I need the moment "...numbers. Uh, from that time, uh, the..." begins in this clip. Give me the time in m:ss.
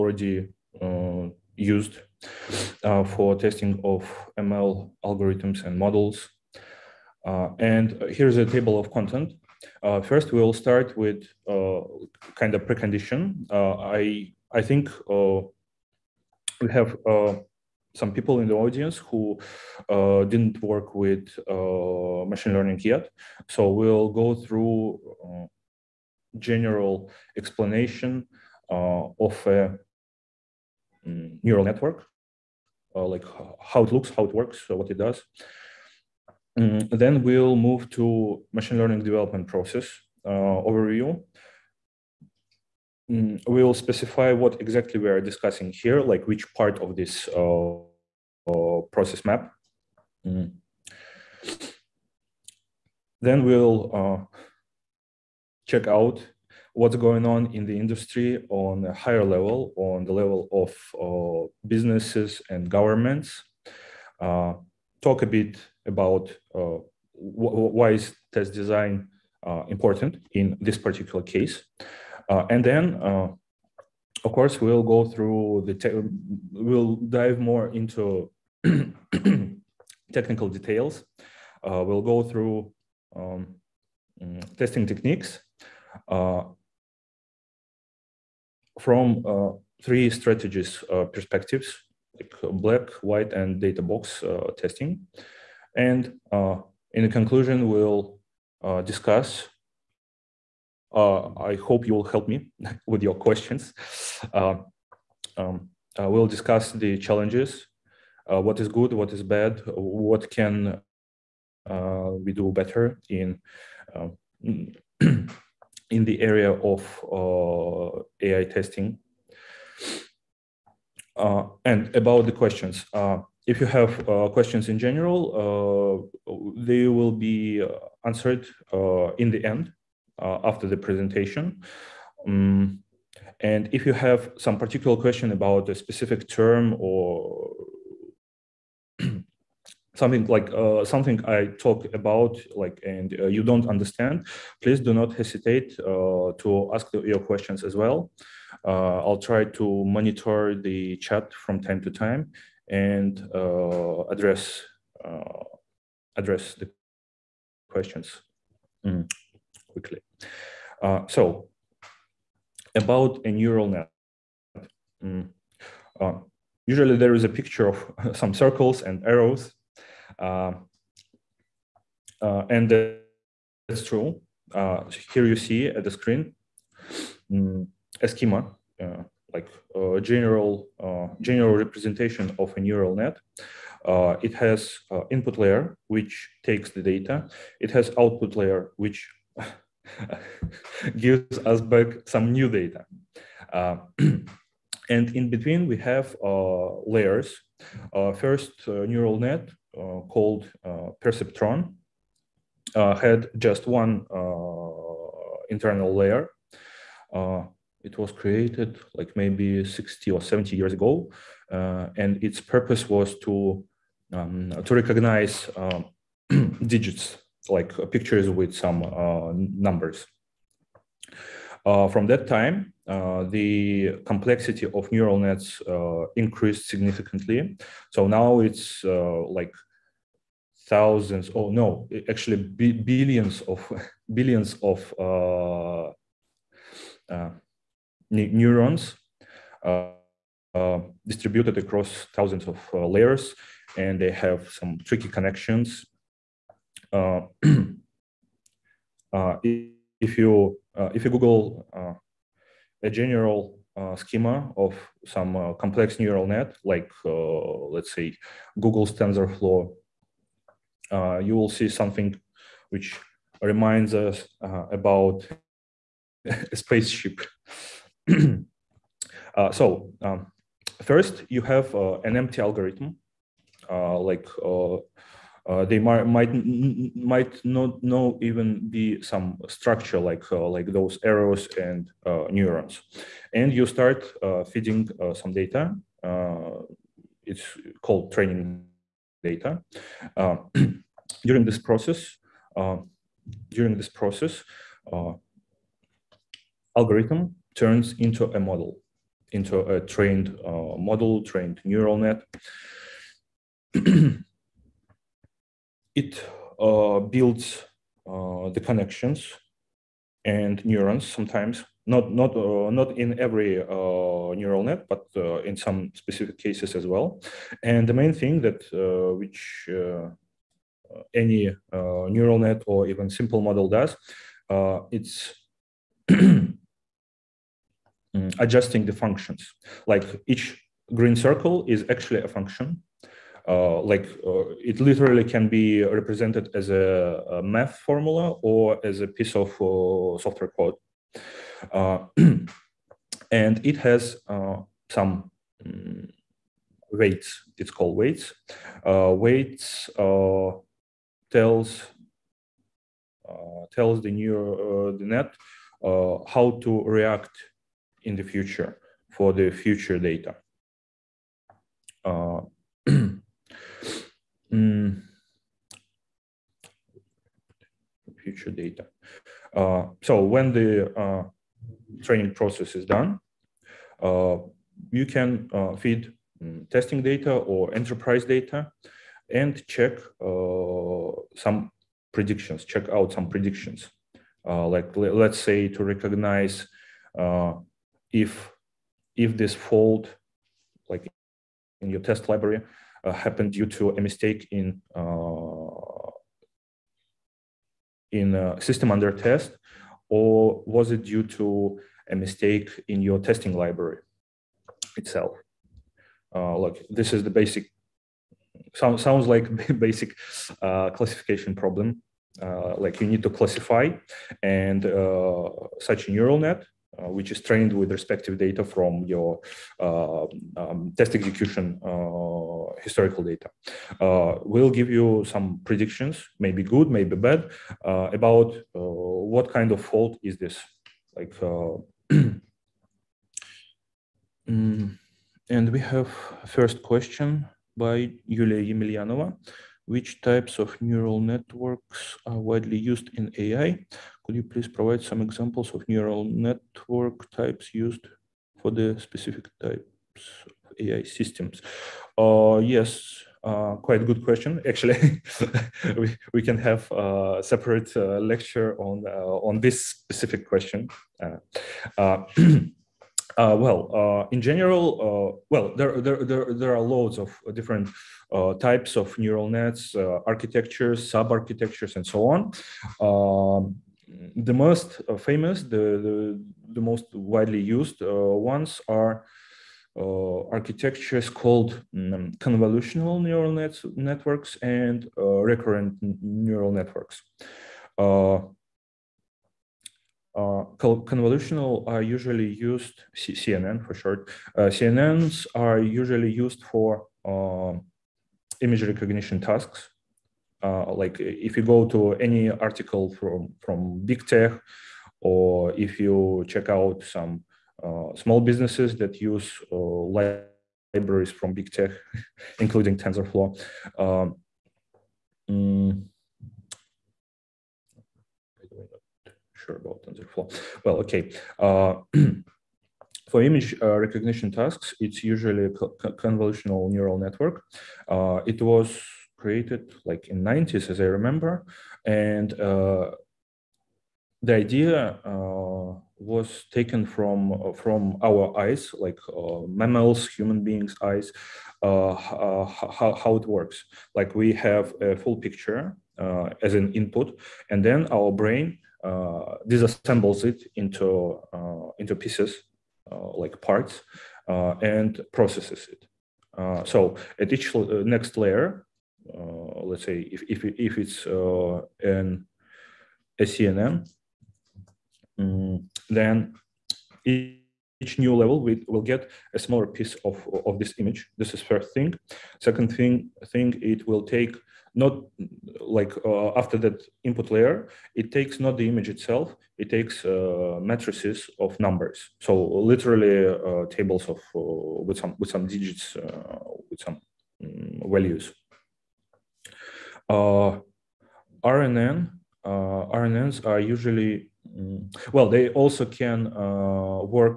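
3:39.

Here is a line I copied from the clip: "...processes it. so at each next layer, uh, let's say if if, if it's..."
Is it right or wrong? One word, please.
right.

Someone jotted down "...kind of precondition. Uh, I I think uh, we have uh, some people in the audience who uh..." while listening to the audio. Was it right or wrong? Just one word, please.
right.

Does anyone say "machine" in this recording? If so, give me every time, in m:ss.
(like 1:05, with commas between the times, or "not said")
0:22, 0:38.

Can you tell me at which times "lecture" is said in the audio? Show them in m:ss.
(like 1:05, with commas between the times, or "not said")
7:38.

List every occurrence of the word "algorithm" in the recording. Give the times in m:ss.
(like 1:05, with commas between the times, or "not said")
0:05, 4:32, 4:56.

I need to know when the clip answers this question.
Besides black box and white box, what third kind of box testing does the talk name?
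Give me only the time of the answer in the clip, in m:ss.
1:33.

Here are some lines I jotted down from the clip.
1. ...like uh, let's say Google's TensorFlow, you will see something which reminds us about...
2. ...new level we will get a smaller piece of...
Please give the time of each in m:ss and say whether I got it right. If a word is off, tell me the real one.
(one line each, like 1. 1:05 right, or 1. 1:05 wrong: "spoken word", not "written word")
1. 4:16 right
2. 9:28 right.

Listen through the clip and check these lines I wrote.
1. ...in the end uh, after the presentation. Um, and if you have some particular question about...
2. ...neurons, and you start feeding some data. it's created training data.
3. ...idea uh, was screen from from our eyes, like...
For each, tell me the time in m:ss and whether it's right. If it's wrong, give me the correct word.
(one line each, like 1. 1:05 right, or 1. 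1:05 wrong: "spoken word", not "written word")
1. 2:09 right
2. 4:42 wrong: "called", not "created"
3. 8:54 wrong: "taken", not "screen".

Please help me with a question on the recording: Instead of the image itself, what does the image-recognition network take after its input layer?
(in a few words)
Matrices of numbers.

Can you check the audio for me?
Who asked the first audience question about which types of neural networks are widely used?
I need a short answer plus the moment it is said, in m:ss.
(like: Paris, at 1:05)
Yulia Emelianova, at 7:18.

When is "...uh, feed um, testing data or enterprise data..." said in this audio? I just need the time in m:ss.
6:15.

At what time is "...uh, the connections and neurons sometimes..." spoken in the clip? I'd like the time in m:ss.
5:08.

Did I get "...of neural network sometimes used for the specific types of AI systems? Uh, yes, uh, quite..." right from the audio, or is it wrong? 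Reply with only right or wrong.
wrong.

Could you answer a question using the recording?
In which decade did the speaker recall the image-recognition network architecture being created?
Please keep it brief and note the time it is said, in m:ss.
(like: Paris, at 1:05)
1990s, at 8:50.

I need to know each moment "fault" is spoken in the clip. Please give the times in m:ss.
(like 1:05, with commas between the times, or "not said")
6:29, 7:09.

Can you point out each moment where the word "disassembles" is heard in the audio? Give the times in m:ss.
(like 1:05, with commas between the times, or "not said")
9:09.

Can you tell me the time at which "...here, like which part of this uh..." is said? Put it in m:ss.
0:45.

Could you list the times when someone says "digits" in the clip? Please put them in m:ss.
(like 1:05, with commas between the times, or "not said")
3:36, 9:45.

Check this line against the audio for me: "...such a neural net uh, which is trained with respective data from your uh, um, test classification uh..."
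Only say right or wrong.
wrong.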